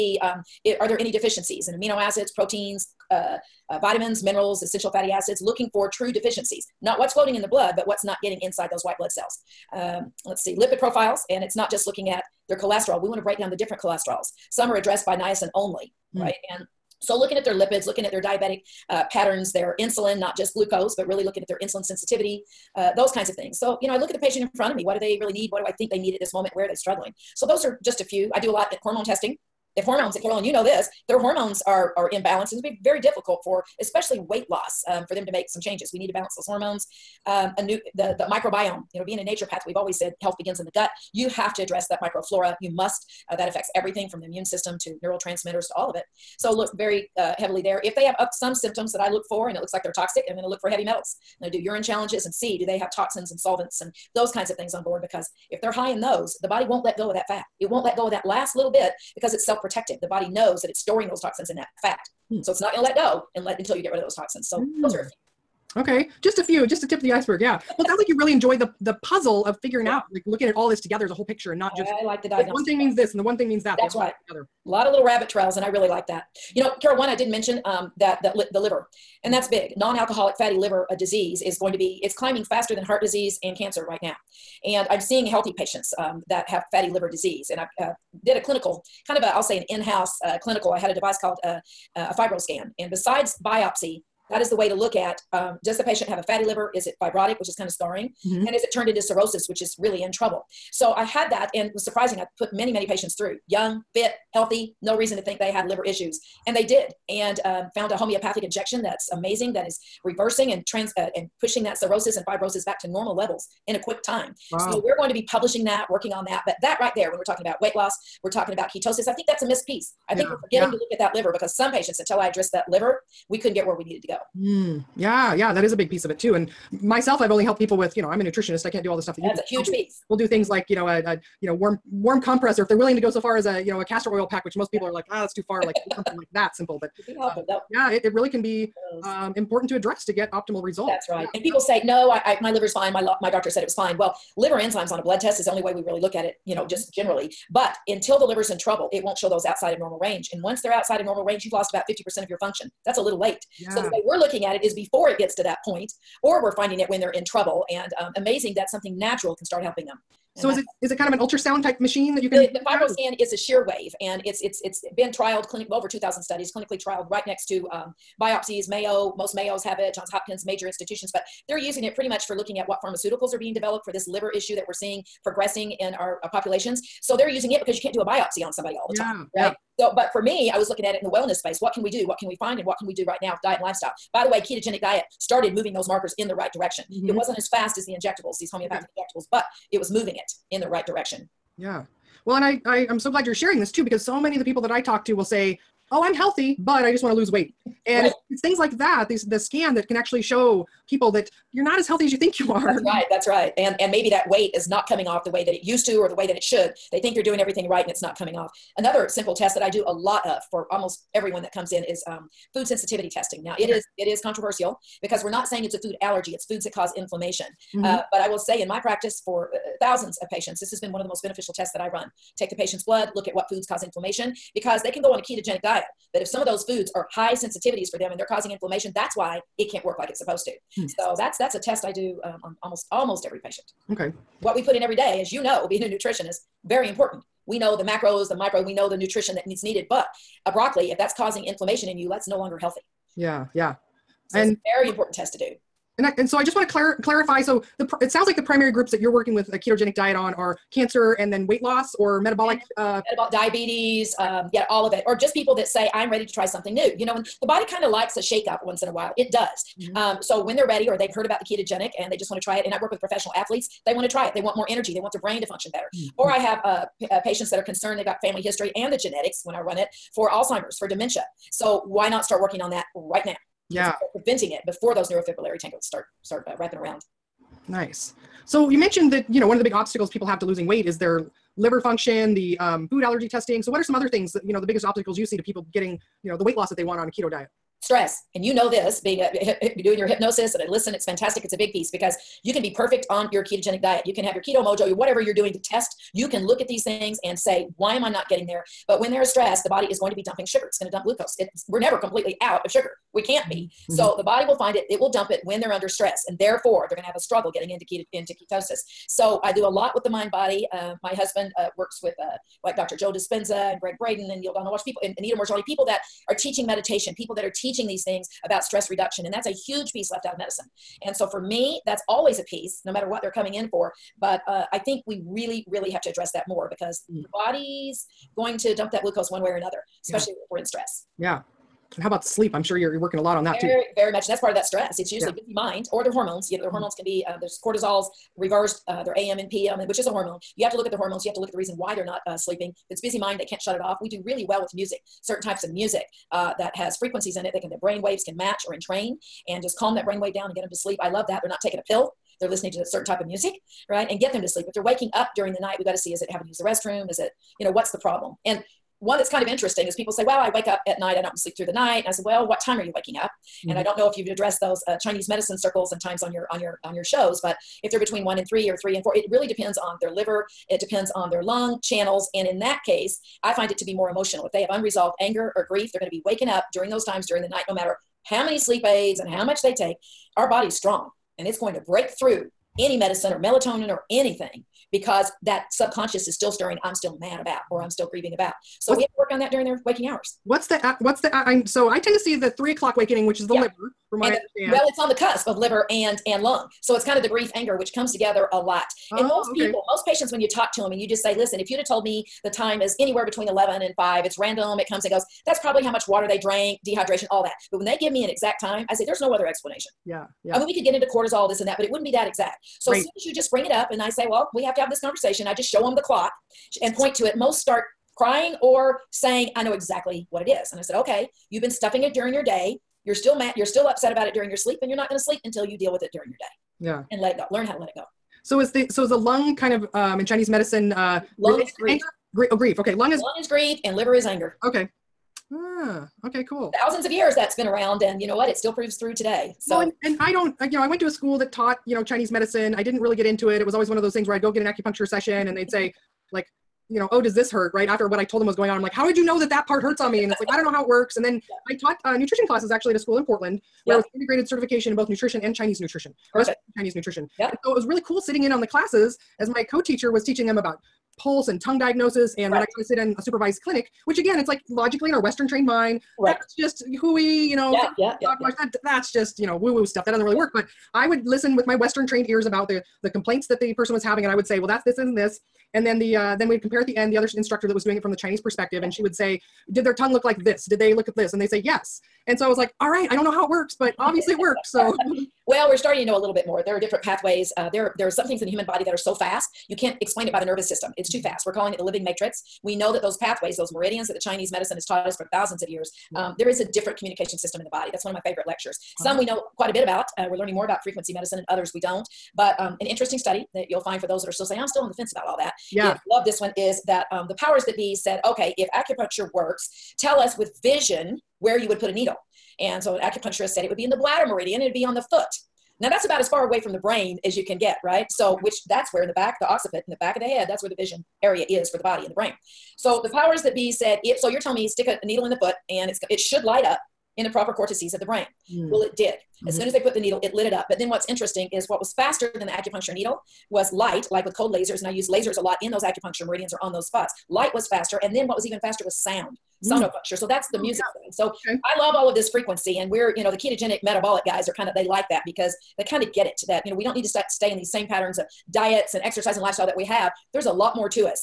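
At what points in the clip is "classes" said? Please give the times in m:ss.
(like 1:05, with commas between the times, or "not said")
7:32, 7:38.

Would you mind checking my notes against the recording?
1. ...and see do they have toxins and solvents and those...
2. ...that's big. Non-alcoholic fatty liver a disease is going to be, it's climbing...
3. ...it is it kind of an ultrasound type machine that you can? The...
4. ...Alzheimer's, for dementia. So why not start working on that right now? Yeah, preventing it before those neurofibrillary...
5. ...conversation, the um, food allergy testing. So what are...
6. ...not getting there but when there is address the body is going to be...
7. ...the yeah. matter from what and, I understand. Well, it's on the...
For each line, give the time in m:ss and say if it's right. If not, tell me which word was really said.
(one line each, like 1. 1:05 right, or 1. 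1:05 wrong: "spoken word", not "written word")
1. 0:52 right
2. 1:19 right
3. 2:40 right
4. 4:30 right
5. 4:41 wrong: "function", not "conversation"
6. 4:58 wrong: "stress", not "address"
7. 6:33 wrong: "liver", not "matter".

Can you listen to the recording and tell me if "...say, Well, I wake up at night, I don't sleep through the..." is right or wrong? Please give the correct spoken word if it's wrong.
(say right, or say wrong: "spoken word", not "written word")
right.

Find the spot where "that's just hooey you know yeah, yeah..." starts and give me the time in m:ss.
7:46.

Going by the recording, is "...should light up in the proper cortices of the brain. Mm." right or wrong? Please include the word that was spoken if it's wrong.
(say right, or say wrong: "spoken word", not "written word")
right.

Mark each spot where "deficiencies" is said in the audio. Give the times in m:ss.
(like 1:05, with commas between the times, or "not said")
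0:01, 0:06.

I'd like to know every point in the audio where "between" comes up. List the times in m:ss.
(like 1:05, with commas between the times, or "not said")
6:07, 6:43.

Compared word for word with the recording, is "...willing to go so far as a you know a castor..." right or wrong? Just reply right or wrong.
right.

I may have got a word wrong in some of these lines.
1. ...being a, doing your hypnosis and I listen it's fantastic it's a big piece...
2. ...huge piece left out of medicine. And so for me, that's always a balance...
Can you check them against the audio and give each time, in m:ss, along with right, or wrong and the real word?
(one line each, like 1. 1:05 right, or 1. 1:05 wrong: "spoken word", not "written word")
1. 4:48 right
2. 5:19 wrong: "piece", not "balance".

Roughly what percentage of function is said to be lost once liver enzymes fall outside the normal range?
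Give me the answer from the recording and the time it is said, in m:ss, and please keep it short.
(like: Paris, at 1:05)
50%, at 2:31.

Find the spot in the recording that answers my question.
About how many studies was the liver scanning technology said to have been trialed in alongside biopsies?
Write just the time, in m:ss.
2:45.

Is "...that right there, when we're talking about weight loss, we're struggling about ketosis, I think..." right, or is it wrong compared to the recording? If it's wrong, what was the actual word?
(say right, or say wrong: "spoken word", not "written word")
wrong: "talking", not "struggling".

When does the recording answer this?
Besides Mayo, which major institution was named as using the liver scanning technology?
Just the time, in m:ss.
2:49.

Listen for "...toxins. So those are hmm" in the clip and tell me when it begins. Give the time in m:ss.
1:04.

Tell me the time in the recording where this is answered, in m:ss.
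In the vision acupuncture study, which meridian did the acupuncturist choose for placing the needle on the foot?
8:33.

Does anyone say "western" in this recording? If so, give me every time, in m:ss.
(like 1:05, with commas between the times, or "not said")
7:45, 7:51.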